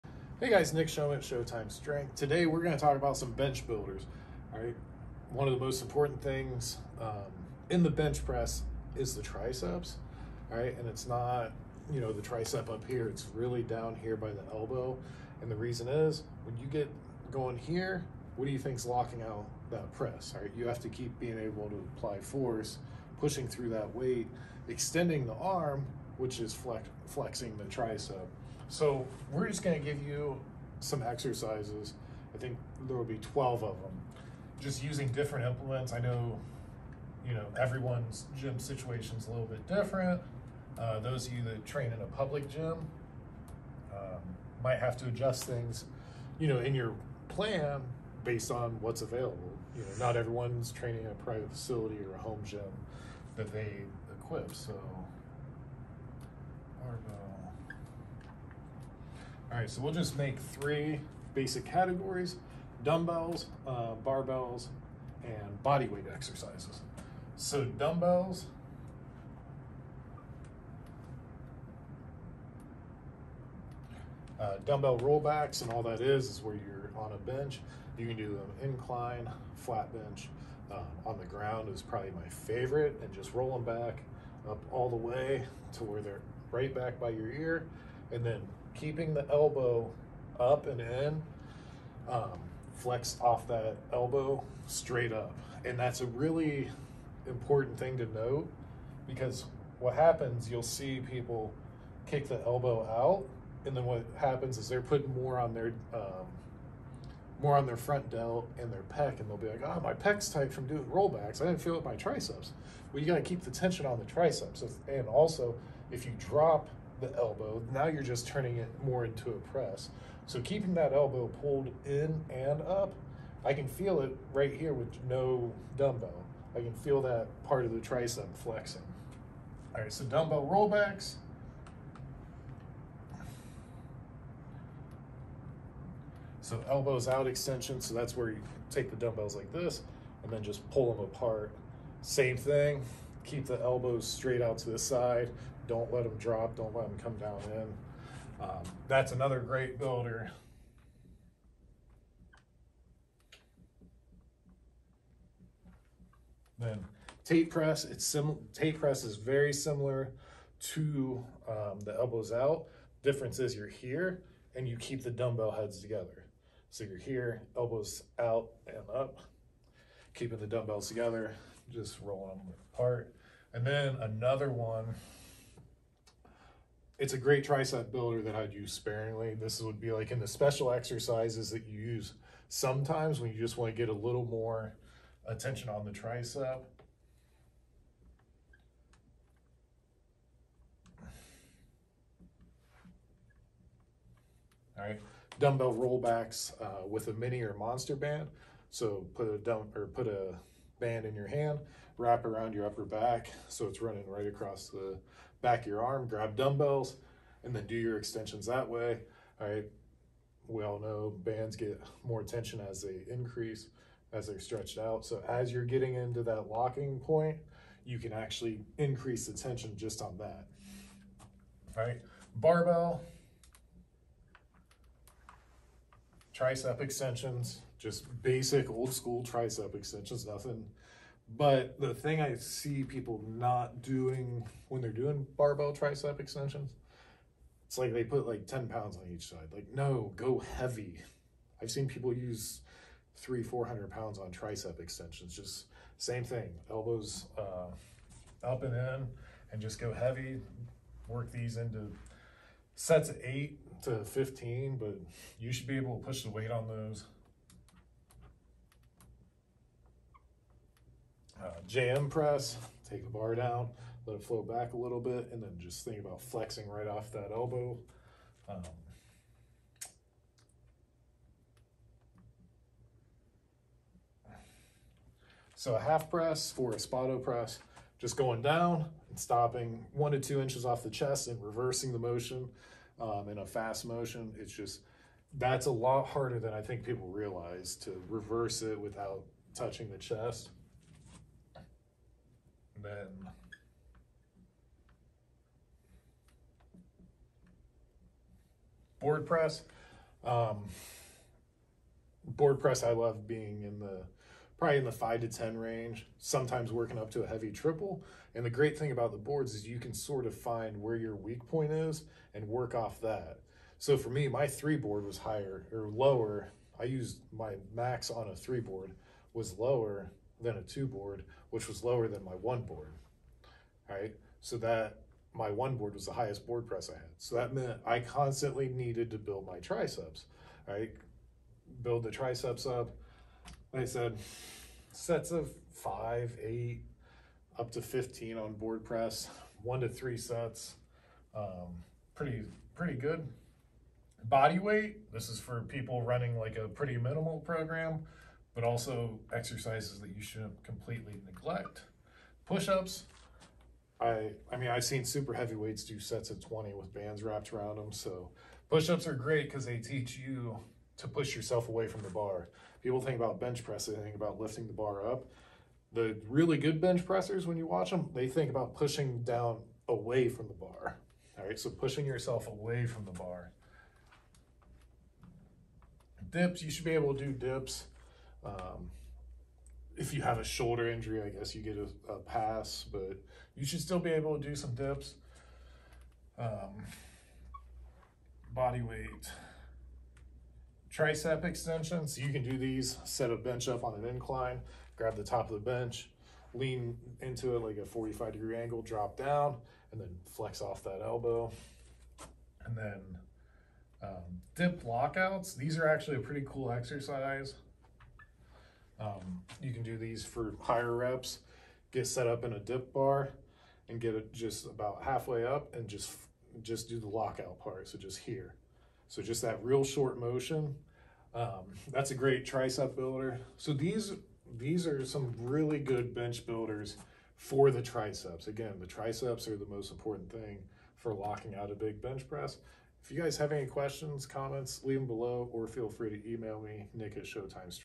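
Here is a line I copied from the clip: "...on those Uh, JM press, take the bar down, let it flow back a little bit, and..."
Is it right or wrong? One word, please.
right.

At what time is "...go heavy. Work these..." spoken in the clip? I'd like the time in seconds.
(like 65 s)
249 s.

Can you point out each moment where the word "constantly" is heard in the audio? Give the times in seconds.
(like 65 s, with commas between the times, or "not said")
327 s.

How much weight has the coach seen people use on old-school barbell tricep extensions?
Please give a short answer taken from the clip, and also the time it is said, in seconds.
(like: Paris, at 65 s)
300 to 400 pounds, at 243 s.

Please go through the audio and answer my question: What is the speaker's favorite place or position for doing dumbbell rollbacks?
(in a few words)
On the ground.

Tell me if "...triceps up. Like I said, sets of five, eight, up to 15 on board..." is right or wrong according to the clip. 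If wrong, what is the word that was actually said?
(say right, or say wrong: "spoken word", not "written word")
right.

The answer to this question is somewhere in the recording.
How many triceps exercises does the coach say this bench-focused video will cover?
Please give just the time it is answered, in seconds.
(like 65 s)
33 s.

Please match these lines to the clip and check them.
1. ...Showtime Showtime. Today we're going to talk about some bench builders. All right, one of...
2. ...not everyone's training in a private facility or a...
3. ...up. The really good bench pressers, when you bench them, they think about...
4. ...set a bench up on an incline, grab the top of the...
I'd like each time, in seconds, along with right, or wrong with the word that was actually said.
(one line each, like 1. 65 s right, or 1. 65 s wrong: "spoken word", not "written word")
1. 1 s wrong: "Strength", not "Showtime"
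2. 50 s right
3. 365 s wrong: "watch", not "bench"
4. 393 s right.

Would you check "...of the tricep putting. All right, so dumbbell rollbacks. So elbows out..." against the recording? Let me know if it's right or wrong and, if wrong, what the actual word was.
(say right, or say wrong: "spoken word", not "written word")
wrong: "flexing", not "putting".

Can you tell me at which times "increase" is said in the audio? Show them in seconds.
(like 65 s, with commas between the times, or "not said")
213 s, 218 s.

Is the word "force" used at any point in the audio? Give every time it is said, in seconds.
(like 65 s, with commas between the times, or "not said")
22 s.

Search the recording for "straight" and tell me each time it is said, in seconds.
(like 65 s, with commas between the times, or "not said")
94 s, 144 s.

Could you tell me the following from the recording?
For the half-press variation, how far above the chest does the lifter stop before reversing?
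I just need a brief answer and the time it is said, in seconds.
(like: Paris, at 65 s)
1 to 2 inches, at 279 s.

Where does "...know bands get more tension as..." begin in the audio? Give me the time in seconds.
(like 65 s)
210 s.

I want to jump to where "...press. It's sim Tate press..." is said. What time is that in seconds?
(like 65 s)
157 s.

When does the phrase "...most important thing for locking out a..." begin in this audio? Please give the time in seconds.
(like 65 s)
429 s.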